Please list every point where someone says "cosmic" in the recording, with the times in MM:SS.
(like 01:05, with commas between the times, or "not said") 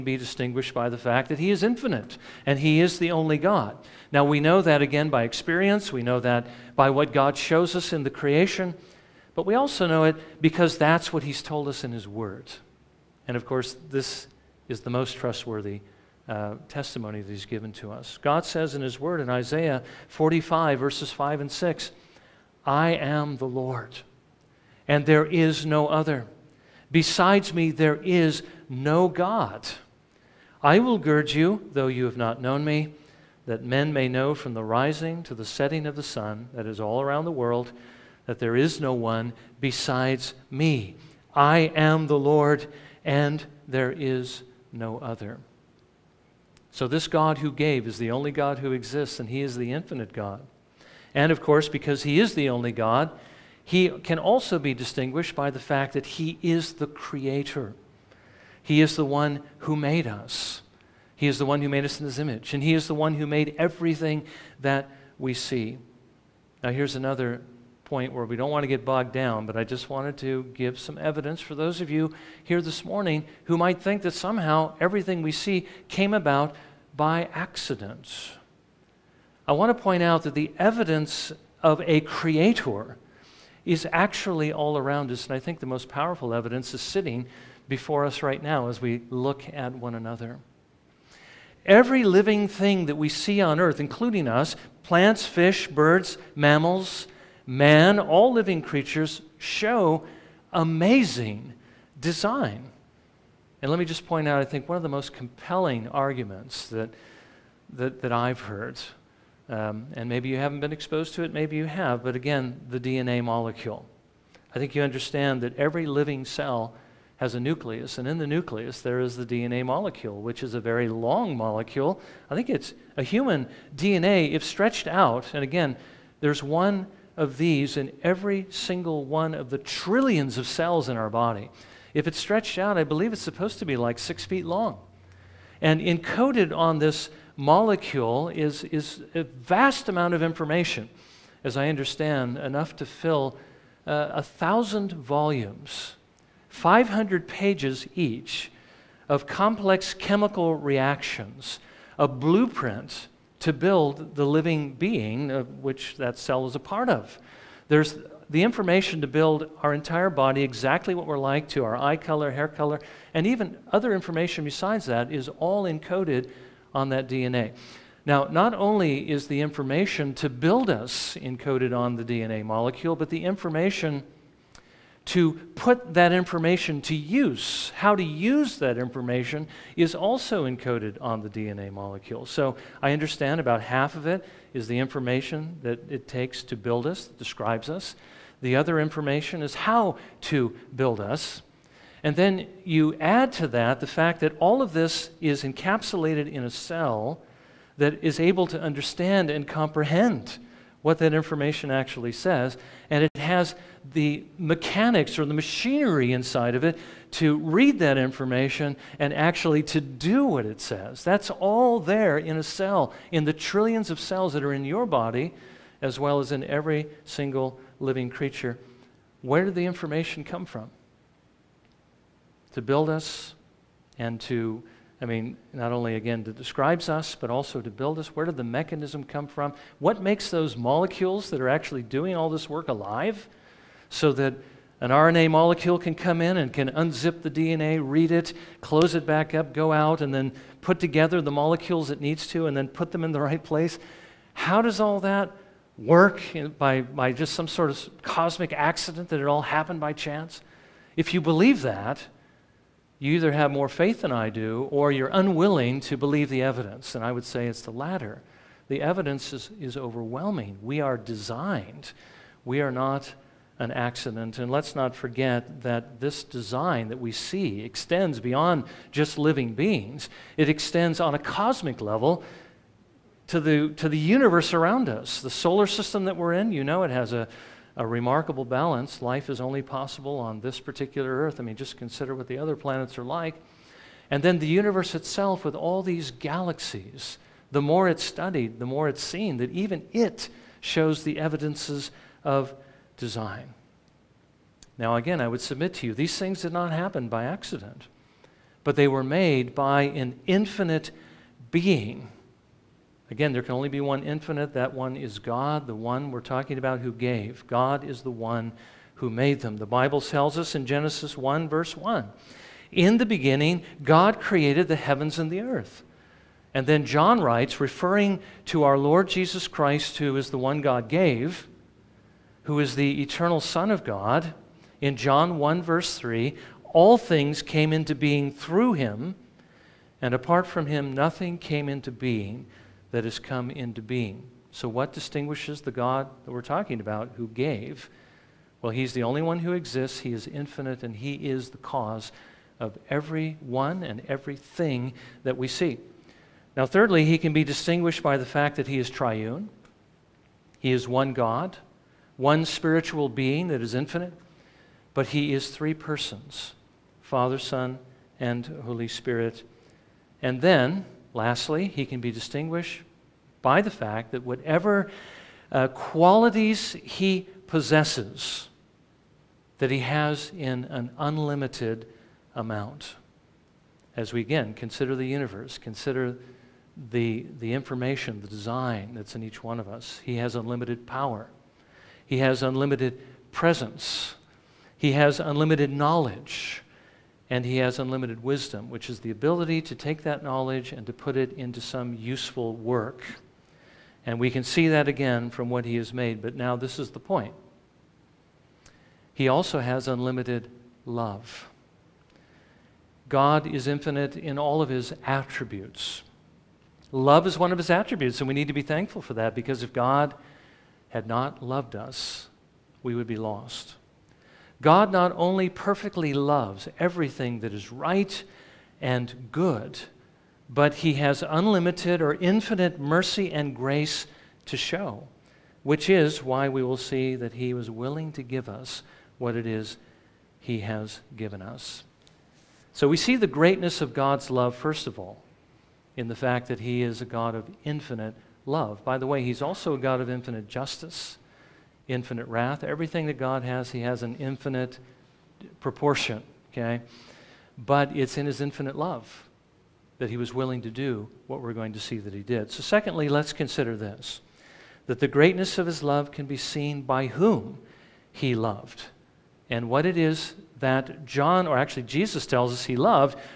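04:08, 04:31.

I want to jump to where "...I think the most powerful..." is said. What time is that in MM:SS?
01:25.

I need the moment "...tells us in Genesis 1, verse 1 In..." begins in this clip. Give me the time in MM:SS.
05:10.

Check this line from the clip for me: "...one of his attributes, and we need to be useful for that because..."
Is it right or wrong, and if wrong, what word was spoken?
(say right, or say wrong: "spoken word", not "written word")
wrong: "thankful", not "useful".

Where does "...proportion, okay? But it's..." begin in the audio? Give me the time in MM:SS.
07:25.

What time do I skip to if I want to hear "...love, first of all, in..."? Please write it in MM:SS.
07:14.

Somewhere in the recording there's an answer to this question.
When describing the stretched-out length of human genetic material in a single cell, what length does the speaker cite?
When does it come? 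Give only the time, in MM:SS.
02:13.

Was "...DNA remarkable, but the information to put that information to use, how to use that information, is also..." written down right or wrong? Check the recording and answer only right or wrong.
wrong.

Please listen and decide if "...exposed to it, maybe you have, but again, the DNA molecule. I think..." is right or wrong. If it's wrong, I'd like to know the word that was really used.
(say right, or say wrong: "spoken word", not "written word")
right.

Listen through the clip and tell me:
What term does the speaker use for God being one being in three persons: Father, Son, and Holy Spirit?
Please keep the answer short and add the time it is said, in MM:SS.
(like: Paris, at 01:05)
triune, at 05:48.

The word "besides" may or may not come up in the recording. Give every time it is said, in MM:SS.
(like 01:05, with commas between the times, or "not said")
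00:26, 00:39, 02:44.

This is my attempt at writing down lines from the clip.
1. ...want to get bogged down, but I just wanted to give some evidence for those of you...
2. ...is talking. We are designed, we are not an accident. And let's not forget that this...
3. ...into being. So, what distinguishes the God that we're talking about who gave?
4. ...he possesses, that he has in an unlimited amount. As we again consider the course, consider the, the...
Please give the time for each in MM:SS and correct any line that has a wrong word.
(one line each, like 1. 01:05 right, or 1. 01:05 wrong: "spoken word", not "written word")
1. 01:08 right
2. 04:19 wrong: "overwhelming", not "talking"
3. 05:33 right
4. 06:06 wrong: "universe", not "course".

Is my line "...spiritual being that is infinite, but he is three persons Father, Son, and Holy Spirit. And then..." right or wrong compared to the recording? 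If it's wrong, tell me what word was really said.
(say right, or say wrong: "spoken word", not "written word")
right.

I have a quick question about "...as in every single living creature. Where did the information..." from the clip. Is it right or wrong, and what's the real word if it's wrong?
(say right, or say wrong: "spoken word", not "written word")
right.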